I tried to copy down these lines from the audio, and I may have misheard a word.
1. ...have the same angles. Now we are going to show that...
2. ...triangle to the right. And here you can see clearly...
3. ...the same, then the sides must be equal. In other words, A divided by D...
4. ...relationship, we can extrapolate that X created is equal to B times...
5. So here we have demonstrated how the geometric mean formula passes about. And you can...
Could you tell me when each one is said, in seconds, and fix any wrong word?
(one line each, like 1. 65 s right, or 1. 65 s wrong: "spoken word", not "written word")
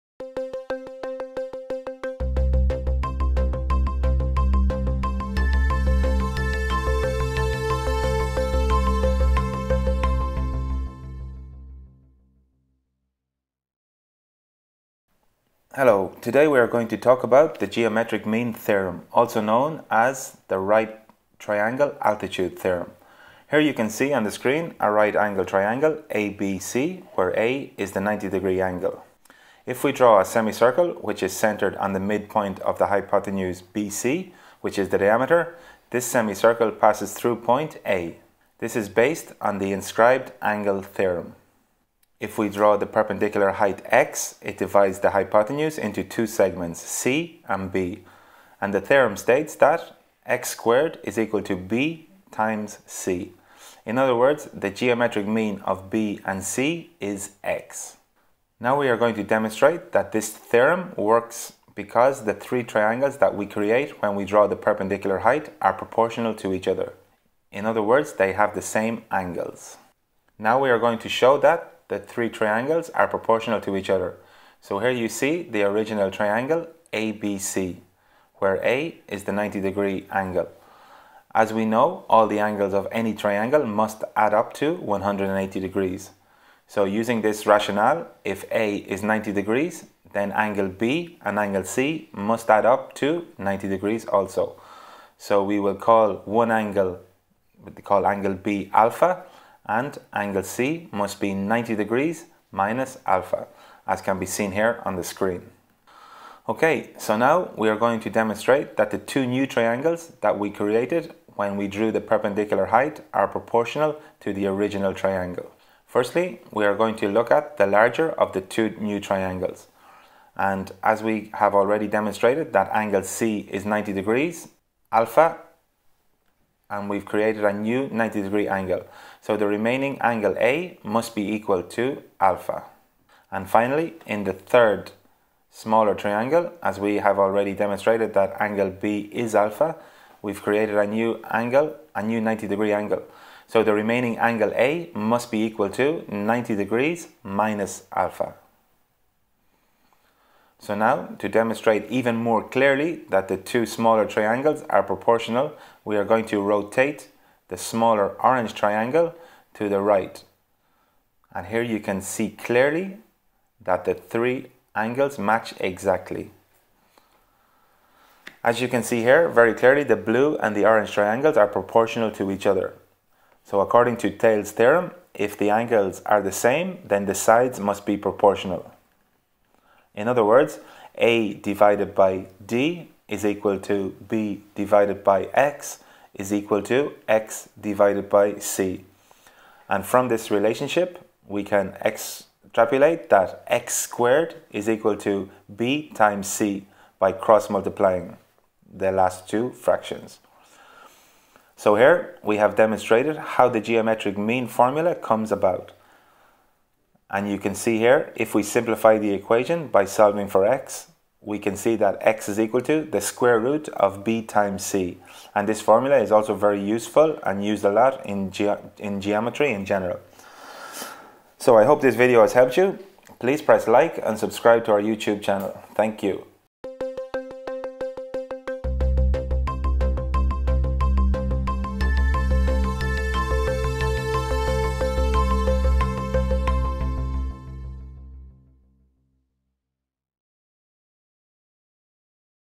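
1. 68 s right
2. 158 s right
3. 176 s wrong: "proportional", not "equal"
4. 190 s wrong: "squared", not "created"
5. 201 s wrong: "comes", not "passes".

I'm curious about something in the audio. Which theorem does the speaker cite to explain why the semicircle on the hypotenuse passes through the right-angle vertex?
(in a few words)
inscribed angle theorem.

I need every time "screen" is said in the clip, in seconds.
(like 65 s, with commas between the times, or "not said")
24 s, 105 s.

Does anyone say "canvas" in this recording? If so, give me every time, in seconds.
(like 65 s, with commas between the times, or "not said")
not said.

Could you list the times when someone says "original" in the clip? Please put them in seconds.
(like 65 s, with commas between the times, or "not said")
75 s, 114 s.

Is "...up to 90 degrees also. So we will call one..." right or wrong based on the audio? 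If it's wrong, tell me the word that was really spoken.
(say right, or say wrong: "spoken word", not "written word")
right.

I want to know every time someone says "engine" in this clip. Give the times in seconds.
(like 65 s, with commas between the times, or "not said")
not said.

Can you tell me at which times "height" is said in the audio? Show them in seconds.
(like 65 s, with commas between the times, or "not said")
43 s, 65 s, 112 s.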